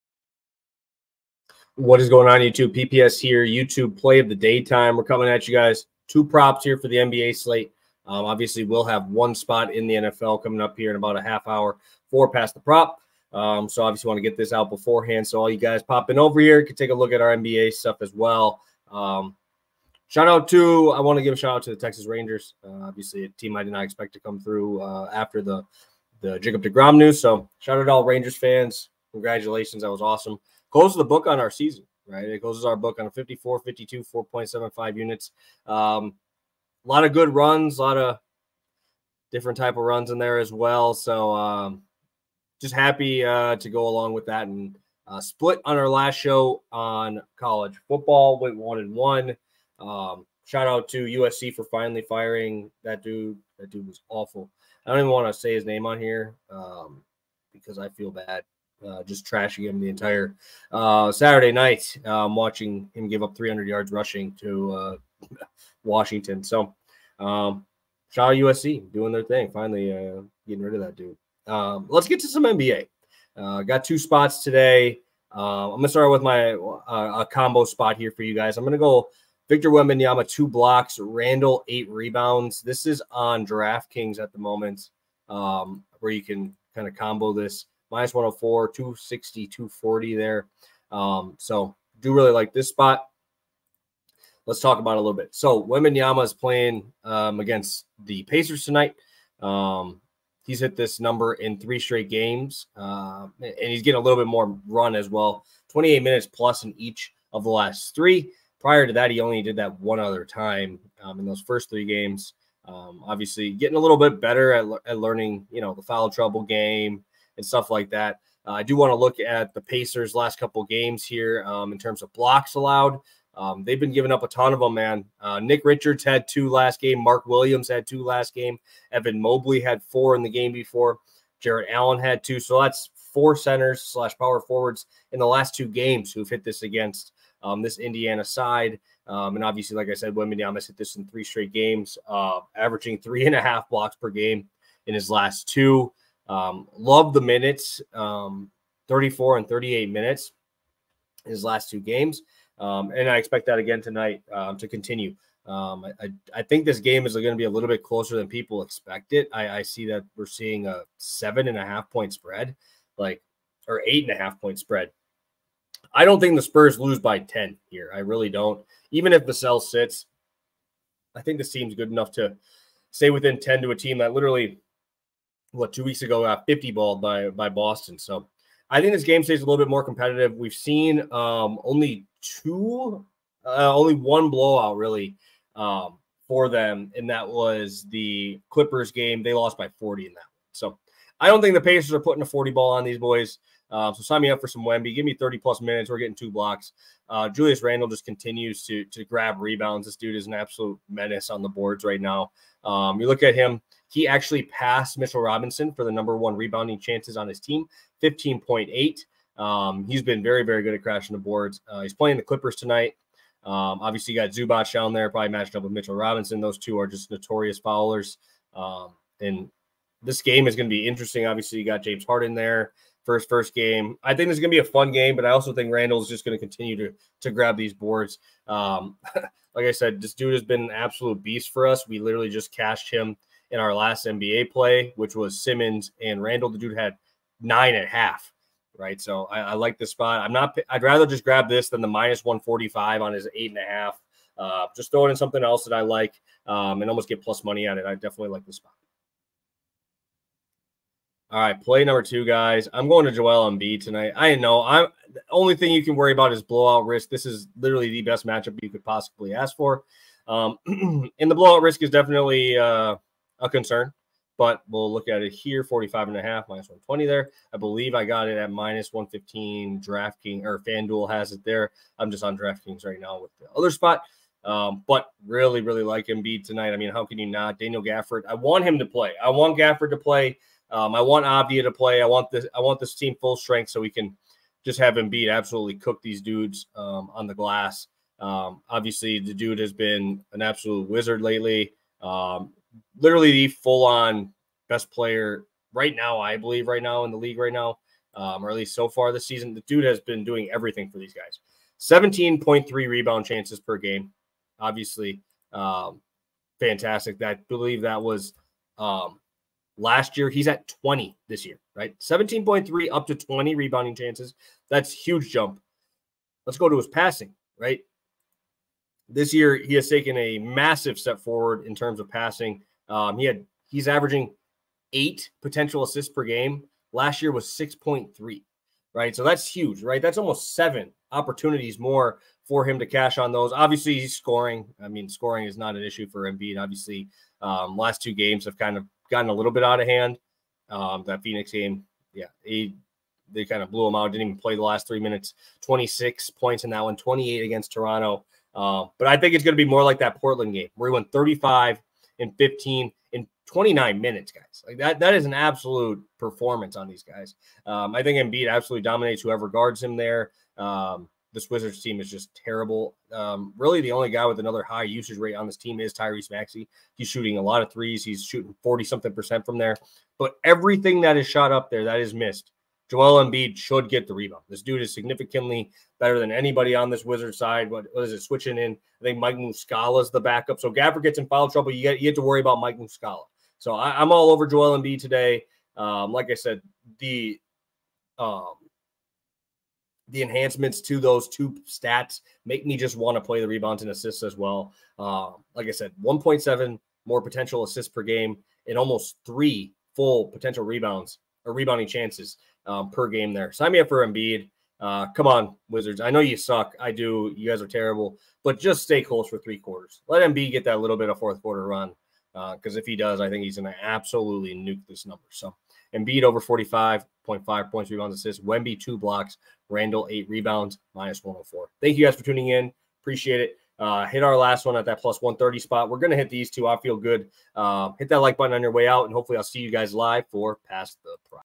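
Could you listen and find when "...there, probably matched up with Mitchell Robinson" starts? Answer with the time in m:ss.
3:34.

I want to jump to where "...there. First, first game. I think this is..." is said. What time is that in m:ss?
3:42.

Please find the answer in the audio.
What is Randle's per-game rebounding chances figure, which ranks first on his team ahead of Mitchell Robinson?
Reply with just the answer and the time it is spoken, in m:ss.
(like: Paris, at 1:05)
15.8, at 3:28.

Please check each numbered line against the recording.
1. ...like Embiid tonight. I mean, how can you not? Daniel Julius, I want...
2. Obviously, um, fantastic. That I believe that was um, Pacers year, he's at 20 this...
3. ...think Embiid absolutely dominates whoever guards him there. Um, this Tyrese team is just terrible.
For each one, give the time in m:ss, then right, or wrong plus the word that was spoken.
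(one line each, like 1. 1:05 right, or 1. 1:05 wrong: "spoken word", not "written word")
1. 4:35 wrong: "Gafford", not "Julius"
2. 5:04 wrong: "Last", not "Pacers"
3. 5:58 wrong: "Wizards", not "Tyrese".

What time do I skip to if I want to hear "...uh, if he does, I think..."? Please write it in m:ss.
6:52.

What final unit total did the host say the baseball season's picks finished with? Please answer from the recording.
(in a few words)
4.75 units.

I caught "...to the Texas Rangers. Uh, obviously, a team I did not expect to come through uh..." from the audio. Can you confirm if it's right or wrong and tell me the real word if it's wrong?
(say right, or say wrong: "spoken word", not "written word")
right.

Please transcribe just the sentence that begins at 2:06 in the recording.
Mark Williams had two last game.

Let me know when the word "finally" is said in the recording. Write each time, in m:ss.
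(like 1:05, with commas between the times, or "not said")
0:51, 1:09.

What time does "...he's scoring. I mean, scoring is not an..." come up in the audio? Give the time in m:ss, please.
5:33.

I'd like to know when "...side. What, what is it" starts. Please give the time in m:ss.
6:17.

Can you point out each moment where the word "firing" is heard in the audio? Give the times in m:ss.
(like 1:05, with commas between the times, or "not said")
0:52.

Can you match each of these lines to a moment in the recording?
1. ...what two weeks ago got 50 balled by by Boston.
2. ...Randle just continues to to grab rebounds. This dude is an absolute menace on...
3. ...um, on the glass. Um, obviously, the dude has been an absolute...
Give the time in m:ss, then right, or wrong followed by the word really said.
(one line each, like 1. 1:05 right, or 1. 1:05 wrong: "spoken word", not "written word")
1. 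2:55 right
2. 3:17 right
3. 4:46 right.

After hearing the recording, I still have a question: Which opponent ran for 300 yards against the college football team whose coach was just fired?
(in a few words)
Washington.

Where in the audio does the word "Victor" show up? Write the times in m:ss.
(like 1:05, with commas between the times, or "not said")
1:19.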